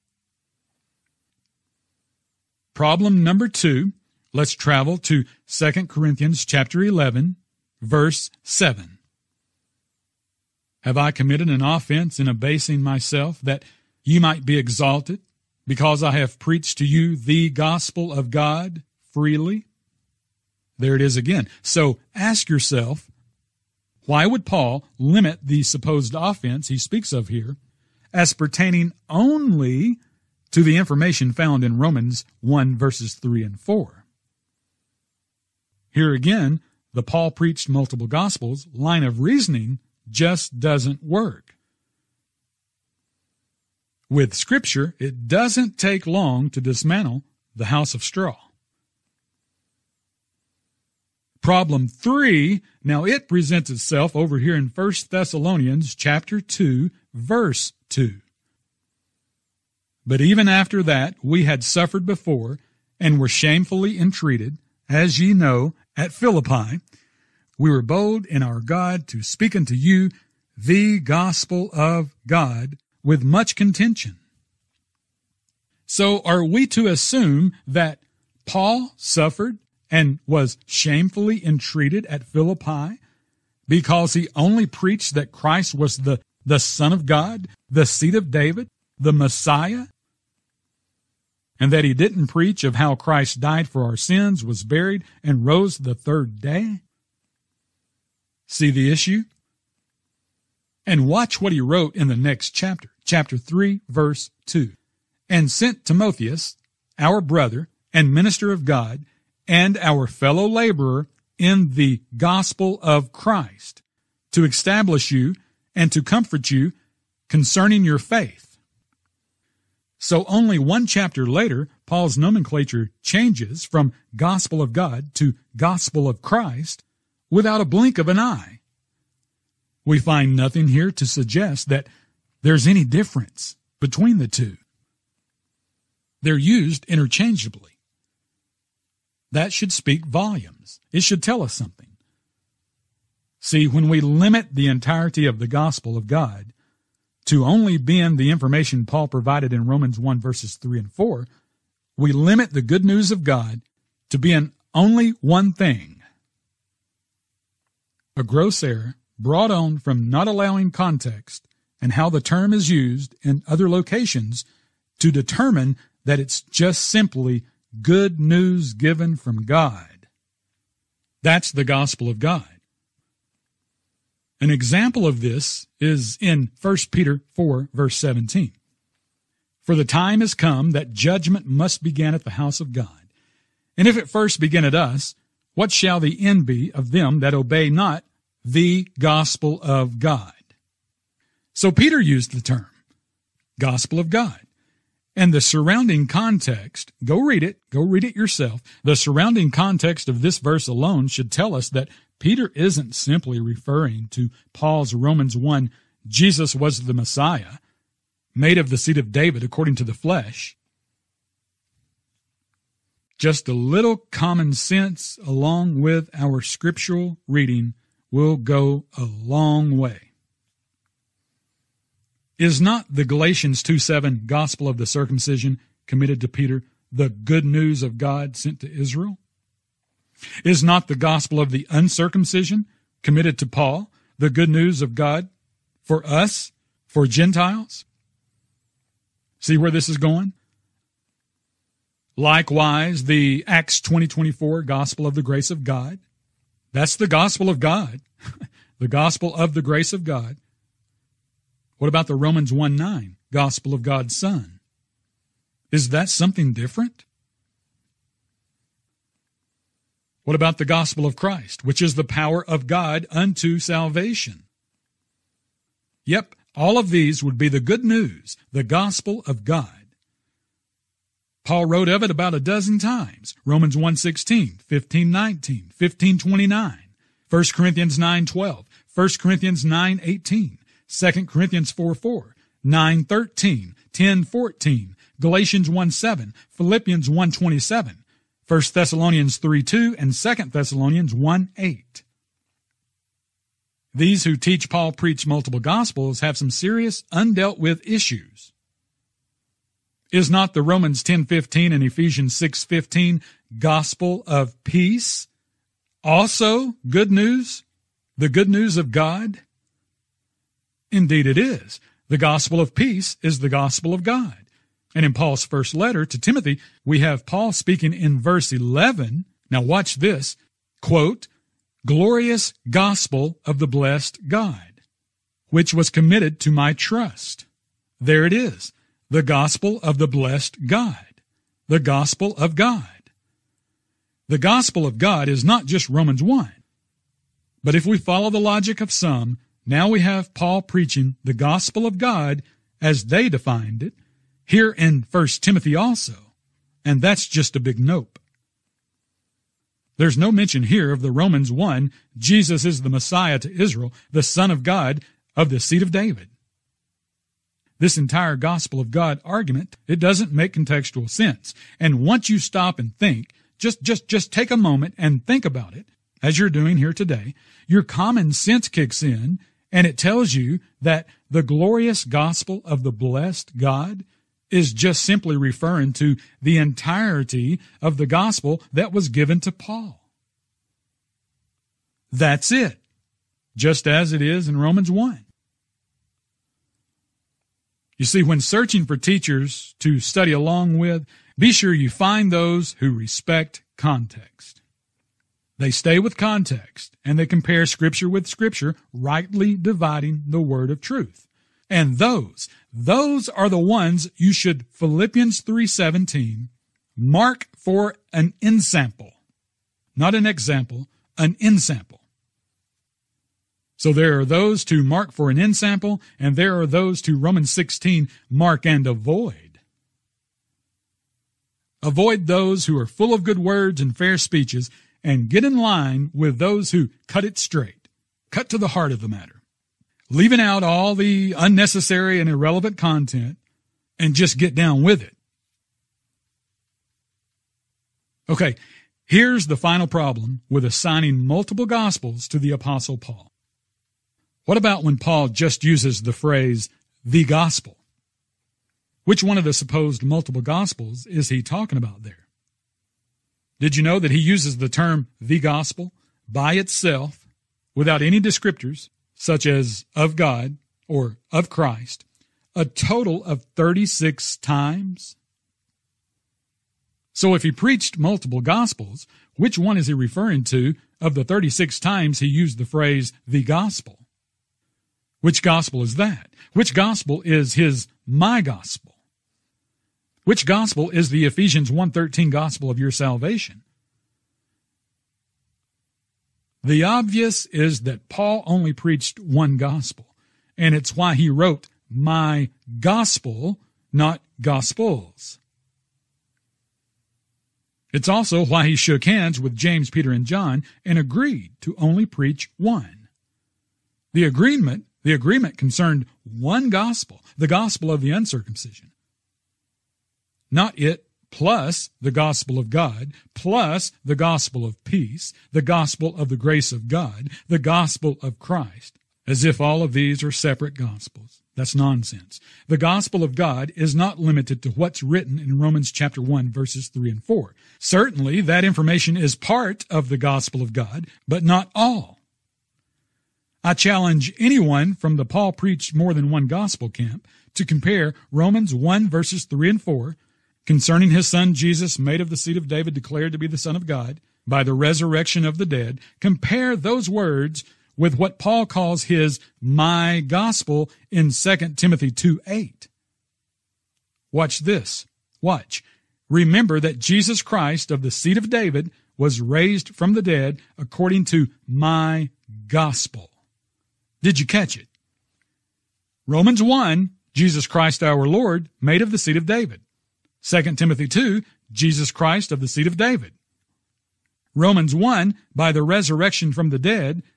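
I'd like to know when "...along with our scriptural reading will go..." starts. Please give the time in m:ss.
3:35.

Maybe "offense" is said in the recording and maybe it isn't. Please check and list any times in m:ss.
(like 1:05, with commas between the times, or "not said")
0:11, 0:26.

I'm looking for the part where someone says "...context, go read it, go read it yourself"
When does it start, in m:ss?
3:16.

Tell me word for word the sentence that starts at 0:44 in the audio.
With Scripture, it doesn't take long to dismantle the house of straw.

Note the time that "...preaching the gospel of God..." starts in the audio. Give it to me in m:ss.
5:40.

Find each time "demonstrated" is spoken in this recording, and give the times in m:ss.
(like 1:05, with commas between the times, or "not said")
not said.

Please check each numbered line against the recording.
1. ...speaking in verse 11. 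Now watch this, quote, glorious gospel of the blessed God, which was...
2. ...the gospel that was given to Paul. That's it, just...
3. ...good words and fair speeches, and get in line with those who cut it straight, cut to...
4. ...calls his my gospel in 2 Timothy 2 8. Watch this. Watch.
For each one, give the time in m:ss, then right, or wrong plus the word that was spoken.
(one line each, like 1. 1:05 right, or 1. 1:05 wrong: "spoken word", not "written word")
1. 5:17 right
2. 6:17 right
3. 7:03 right
4. 9:08 right.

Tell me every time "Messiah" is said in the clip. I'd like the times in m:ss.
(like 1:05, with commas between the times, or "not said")
1:29, 3:26, 5:52.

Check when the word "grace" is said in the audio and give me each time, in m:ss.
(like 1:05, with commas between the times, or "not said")
4:05, 4:09, 8:36.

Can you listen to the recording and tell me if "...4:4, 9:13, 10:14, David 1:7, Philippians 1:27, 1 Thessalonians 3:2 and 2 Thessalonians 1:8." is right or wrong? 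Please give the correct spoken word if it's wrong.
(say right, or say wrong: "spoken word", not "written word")
wrong: "Galatians", not "David".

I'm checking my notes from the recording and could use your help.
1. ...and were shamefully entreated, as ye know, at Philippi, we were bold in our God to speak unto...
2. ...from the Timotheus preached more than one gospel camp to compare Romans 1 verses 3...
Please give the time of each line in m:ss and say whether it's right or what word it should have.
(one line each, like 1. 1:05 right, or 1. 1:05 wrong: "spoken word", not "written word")
1. 1:02 right
2. 8:54 wrong: "Paul", not "Timotheus".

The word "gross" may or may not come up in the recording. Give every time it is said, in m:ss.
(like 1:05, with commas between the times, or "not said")
2:38.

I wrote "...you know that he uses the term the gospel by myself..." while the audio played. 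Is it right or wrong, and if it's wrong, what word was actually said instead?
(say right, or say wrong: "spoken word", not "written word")
wrong: "itself", not "myself".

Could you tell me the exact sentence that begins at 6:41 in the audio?
And those, those are the ones you should Philippians 3:17 mark for an ensample.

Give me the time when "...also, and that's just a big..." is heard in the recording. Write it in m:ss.
5:45.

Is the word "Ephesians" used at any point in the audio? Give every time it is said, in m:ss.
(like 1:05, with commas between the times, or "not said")
5:01, 8:01.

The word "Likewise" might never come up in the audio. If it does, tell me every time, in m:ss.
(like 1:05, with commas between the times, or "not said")
4:02.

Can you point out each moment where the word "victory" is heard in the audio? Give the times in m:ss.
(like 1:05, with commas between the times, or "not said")
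not said.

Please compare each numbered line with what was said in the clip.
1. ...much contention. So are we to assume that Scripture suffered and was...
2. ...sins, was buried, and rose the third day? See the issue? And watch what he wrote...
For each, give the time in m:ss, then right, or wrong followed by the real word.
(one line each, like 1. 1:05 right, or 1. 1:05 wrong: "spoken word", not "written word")
1. 1:13 wrong: "Paul", not "Scripture"
2. 1:33 right.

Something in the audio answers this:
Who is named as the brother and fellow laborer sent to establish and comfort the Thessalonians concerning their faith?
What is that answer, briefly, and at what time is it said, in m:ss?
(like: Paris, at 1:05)
Timotheus, at 1:45.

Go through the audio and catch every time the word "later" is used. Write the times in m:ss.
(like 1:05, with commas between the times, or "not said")
2:01.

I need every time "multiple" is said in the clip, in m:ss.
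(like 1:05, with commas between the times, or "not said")
0:37, 4:55, 7:21, 7:30, 7:47.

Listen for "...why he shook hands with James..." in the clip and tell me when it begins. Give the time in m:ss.
8:18.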